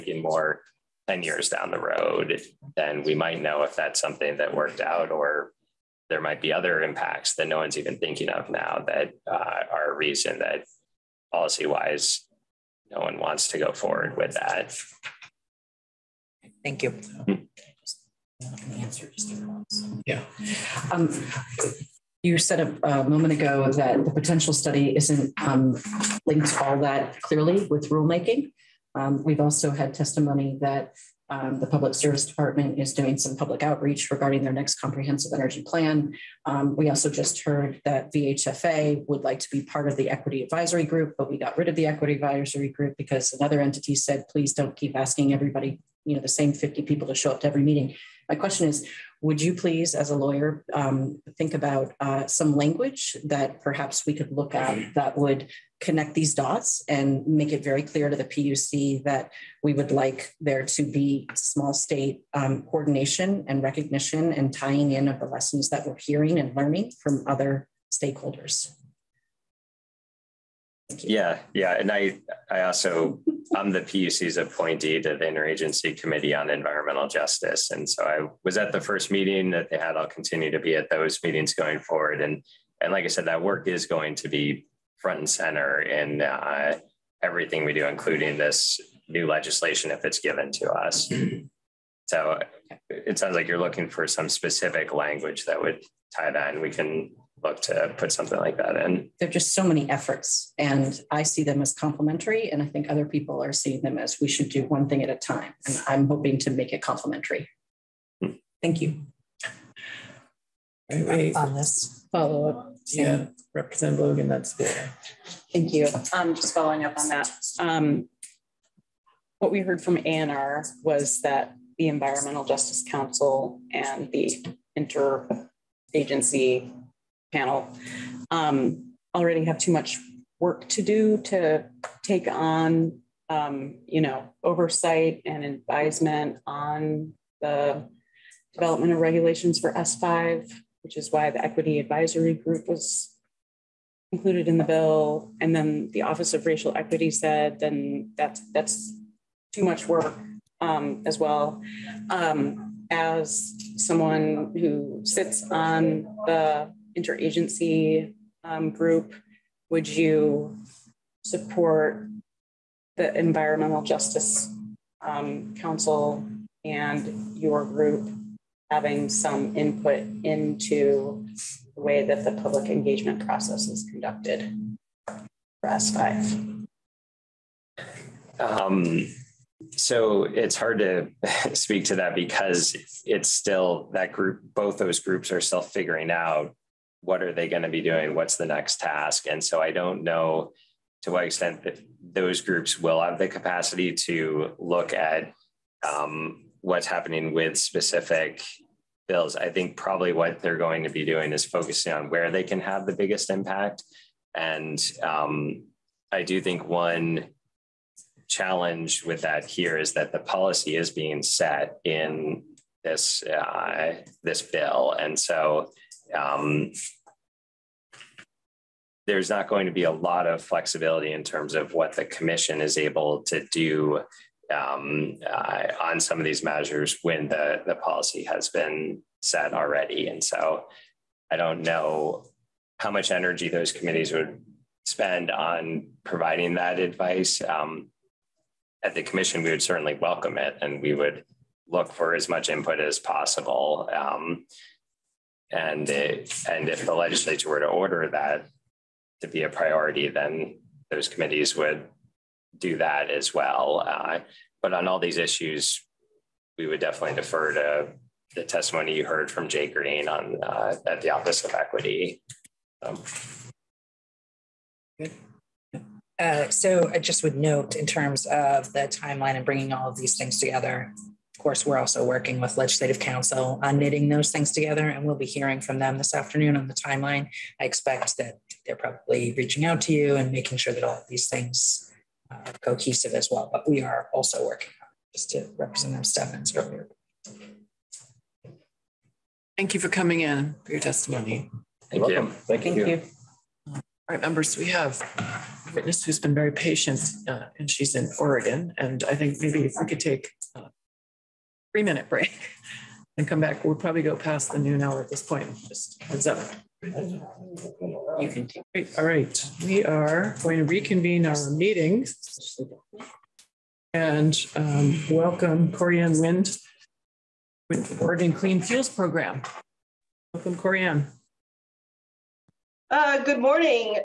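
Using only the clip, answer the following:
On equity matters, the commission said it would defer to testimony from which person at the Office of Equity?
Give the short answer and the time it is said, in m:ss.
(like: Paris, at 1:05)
Jay Green, at 4:19.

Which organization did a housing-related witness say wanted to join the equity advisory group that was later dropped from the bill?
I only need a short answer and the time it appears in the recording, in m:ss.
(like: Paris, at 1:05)
VHFA, at 0:38.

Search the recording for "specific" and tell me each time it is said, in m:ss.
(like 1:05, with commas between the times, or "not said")
1:34, 3:17.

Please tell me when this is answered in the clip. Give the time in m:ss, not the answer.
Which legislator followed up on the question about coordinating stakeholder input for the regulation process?
1:53.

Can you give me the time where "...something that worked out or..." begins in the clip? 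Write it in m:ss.
0:03.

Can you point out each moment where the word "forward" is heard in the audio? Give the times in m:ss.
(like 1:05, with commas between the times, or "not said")
0:13, 1:21.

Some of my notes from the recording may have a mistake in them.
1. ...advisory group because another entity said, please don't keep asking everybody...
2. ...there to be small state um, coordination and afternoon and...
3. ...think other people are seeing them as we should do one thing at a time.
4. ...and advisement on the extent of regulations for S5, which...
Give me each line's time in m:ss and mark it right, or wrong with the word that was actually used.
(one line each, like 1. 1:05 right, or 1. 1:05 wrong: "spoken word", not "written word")
1. 0:42 right
2. 1:00 wrong: "recognition", not "afternoon"
3. 1:42 right
4. 2:15 wrong: "development", not "extent".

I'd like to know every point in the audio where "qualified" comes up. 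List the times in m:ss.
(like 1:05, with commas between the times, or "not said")
not said.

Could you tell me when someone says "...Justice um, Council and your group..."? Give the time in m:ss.
2:43.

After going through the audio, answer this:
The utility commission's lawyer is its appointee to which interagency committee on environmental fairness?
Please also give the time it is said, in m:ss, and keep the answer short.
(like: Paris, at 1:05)
Interagency Committee on Environmental Justice, at 1:15.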